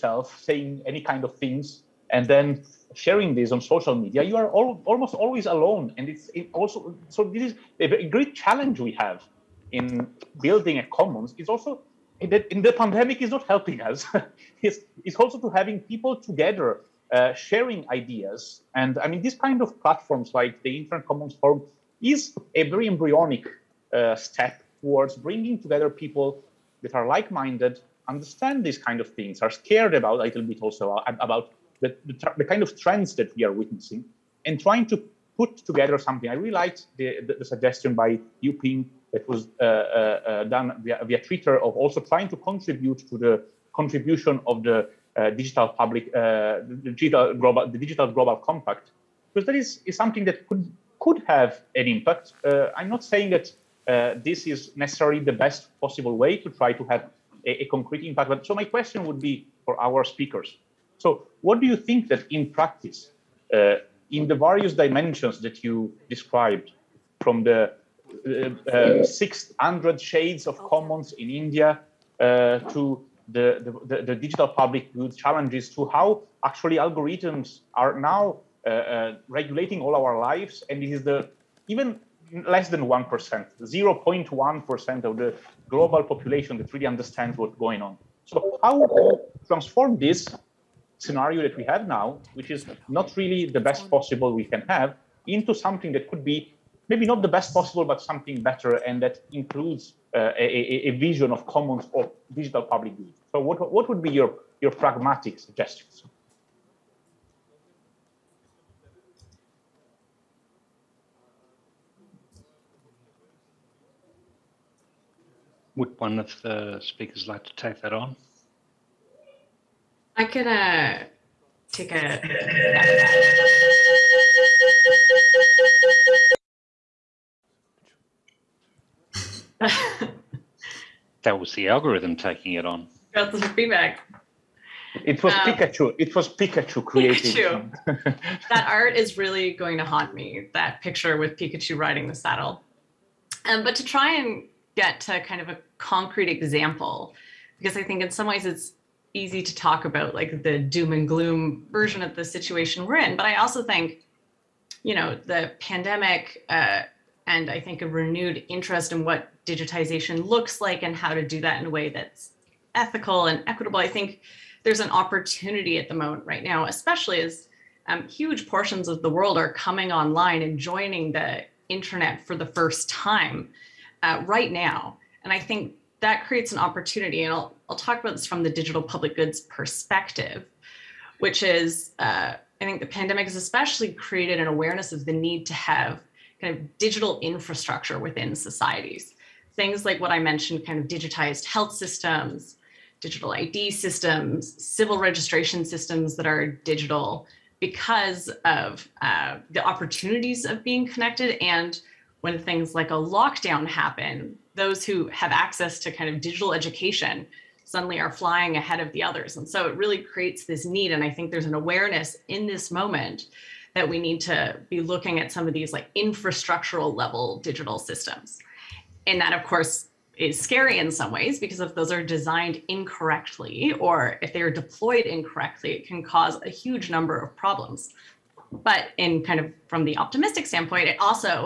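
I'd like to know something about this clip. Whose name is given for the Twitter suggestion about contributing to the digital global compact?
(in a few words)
Yuping.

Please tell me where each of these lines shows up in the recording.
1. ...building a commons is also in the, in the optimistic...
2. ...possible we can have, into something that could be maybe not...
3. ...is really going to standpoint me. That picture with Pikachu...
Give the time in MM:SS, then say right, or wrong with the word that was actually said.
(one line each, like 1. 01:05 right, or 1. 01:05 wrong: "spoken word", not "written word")
1. 00:10 wrong: "pandemic", not "optimistic"
2. 01:33 right
3. 02:18 wrong: "haunt", not "standpoint".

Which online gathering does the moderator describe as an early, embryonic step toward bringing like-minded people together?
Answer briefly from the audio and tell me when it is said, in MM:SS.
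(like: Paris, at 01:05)
Internet Commons Forum, at 00:20.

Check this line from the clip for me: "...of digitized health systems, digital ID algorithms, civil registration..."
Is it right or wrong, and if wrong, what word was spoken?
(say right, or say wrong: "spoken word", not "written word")
wrong: "systems", not "algorithms".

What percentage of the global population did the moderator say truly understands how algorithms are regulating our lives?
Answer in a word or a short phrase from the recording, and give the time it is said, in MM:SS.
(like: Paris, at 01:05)
0.1%, at 01:23.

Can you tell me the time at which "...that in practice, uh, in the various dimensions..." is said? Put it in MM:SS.
01:02.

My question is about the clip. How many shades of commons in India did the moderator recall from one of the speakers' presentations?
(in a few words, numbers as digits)
600.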